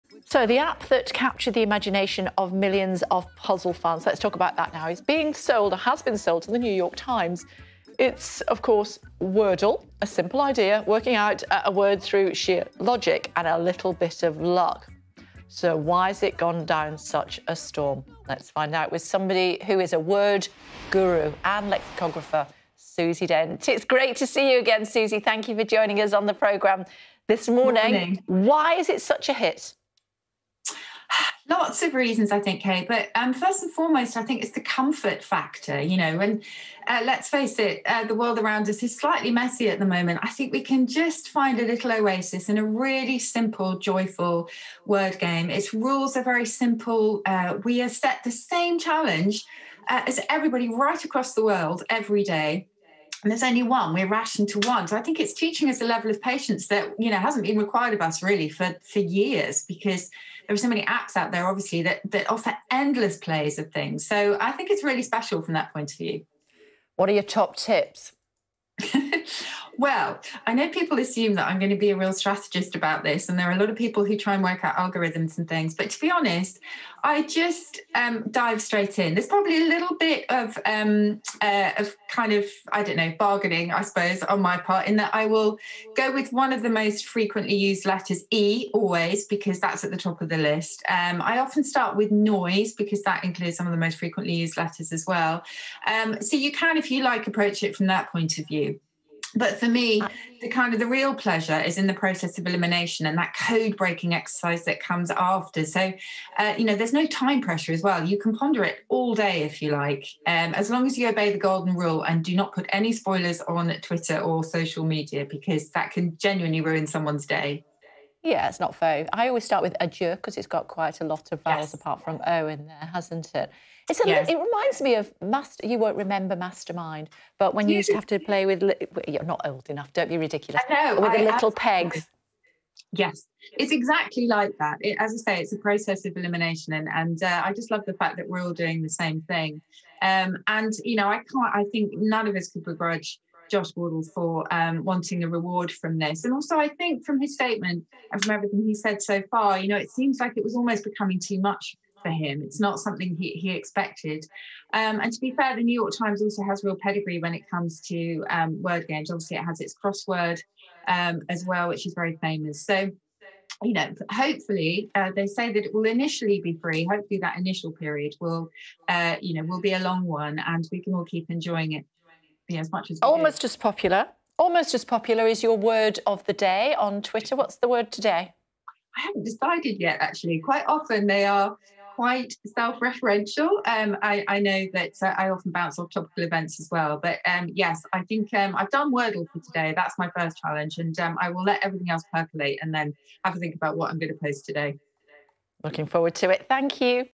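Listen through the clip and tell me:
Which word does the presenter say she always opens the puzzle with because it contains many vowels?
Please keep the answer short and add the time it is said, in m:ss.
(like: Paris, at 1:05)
adieu, at 1:59.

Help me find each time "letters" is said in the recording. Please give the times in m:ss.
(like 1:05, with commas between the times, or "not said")
1:27, 1:34.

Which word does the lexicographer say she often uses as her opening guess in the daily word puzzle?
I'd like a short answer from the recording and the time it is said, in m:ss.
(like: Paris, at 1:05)
noise, at 1:32.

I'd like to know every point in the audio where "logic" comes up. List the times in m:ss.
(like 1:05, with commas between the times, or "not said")
0:12.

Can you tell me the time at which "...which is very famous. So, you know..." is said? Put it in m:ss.
2:41.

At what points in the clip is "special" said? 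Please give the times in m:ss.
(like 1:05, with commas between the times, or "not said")
1:05.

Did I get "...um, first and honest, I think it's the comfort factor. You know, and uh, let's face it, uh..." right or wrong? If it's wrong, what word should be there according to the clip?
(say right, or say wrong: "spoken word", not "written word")
wrong: "foremost", not "honest".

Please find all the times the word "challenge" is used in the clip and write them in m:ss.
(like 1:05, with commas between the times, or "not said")
0:48, 3:10.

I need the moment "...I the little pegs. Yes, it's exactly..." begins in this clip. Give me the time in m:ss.
2:11.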